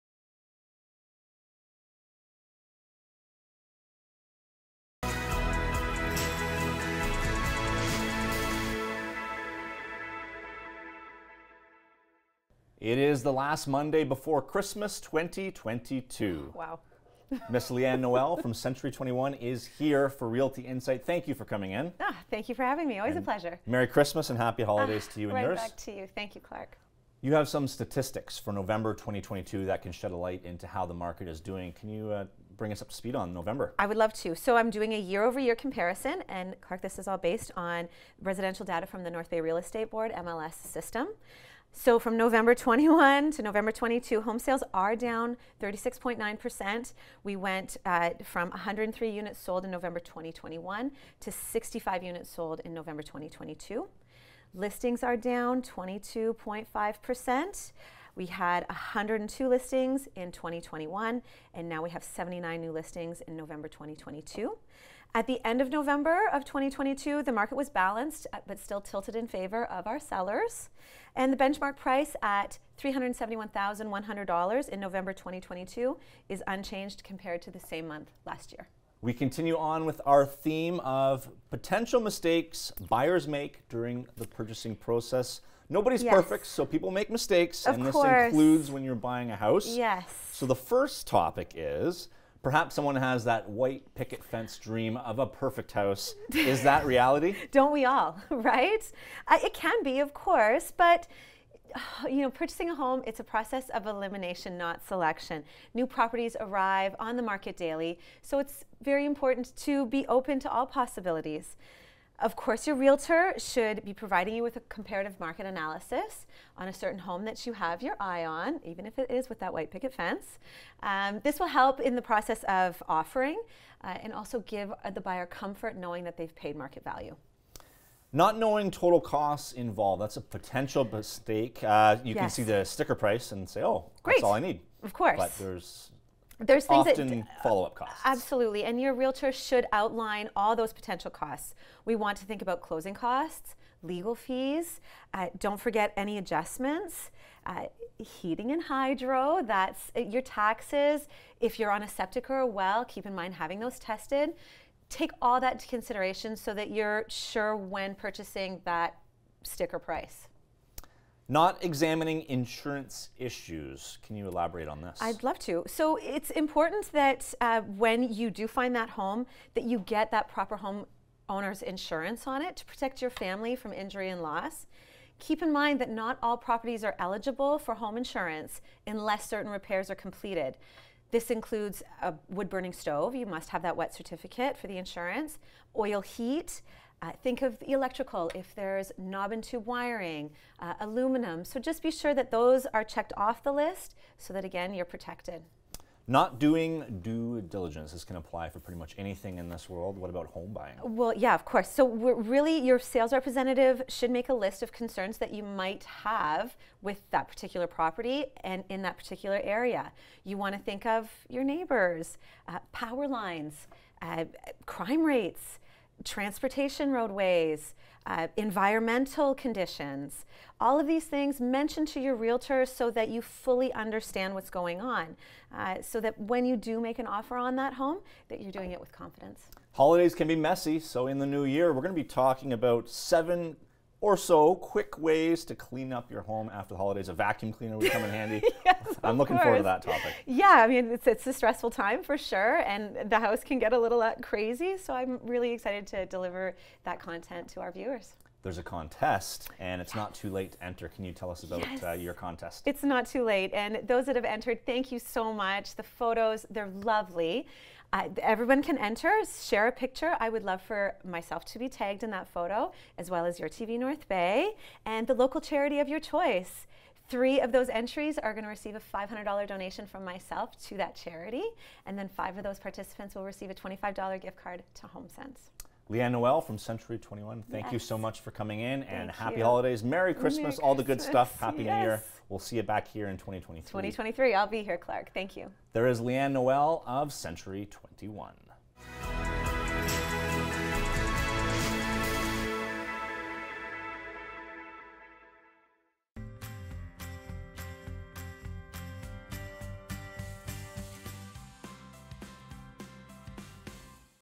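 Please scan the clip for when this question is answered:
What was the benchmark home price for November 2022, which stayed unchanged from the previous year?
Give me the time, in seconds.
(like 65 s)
72 s.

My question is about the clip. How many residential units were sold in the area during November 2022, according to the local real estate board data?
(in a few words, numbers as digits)
65.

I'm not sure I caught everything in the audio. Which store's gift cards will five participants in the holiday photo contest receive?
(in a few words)
HomeSense.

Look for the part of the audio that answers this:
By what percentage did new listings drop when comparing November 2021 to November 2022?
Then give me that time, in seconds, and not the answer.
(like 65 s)
55 s.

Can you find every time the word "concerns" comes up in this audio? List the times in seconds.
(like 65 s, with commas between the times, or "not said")
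204 s.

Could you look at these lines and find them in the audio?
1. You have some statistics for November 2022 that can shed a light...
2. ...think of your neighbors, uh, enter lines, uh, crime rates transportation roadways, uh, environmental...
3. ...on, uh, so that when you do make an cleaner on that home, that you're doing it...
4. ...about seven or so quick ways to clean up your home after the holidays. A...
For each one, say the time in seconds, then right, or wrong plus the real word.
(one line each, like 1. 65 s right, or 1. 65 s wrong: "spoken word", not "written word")
1. 27 s right
2. 210 s wrong: "power", not "enter"
3. 224 s wrong: "offer", not "cleaner"
4. 232 s right.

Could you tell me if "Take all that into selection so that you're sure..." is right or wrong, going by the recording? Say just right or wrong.
wrong.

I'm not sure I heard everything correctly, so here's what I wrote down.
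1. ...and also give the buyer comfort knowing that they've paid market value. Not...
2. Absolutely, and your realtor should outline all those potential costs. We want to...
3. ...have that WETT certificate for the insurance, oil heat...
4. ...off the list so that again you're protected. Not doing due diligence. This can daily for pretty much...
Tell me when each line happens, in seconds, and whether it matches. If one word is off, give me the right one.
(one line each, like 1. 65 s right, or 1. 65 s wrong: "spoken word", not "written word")
1. 124 s right
2. 138 s right
3. 183 s right
4. 193 s wrong: "apply", not "daily".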